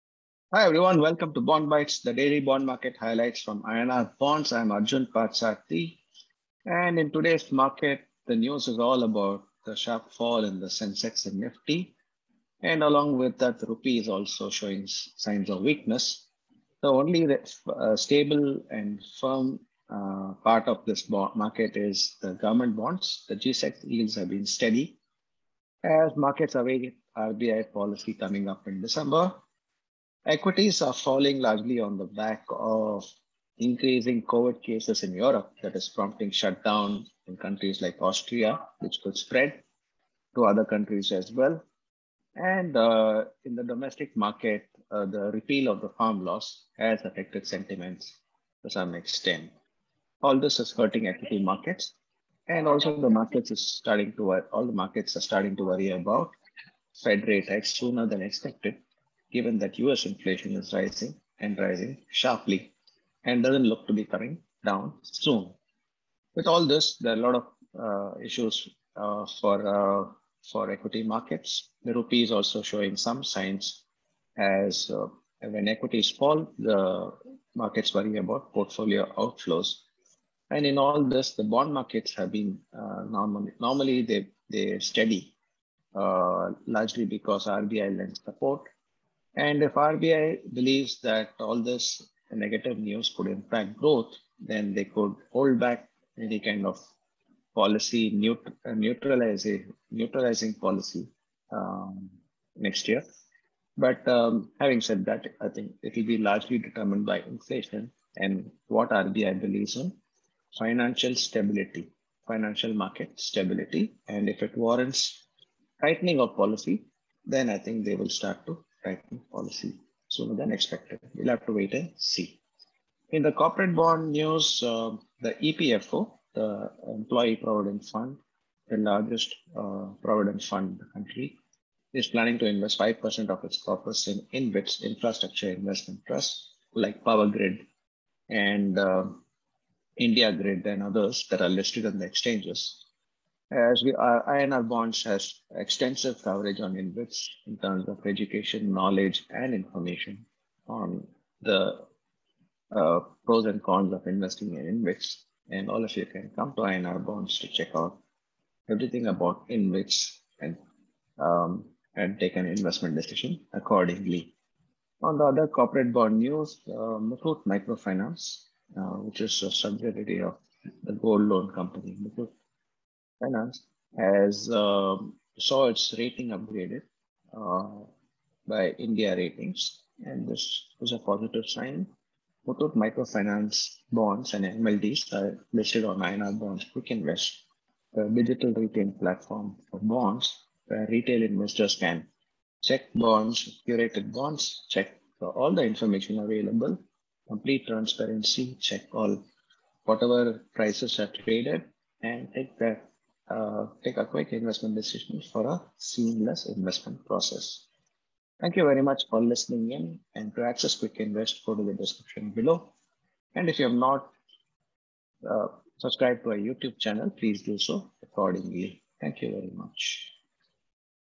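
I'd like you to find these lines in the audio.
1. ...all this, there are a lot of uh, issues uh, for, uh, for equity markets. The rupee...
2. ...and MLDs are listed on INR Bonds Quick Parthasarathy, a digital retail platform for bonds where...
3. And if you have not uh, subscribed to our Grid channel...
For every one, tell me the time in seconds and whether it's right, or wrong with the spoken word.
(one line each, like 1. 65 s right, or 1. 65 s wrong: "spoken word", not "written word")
1. 66 s right
2. 184 s wrong: "Invest", not "Parthasarathy"
3. 213 s wrong: "YouTube", not "Grid".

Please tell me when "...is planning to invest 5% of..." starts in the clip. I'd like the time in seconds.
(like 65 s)
131 s.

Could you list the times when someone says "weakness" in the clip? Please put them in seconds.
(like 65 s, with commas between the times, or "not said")
15 s.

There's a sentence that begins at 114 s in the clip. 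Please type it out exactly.
And if it warrants tightening of policy, then I think they will start to writing policy sooner than expected.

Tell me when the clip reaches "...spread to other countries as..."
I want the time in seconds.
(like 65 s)
39 s.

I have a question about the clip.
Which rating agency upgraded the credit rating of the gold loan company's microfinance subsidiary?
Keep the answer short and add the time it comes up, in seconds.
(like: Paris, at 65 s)
India Ratings, at 178 s.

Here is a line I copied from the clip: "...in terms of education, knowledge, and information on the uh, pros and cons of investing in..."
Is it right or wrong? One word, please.
right.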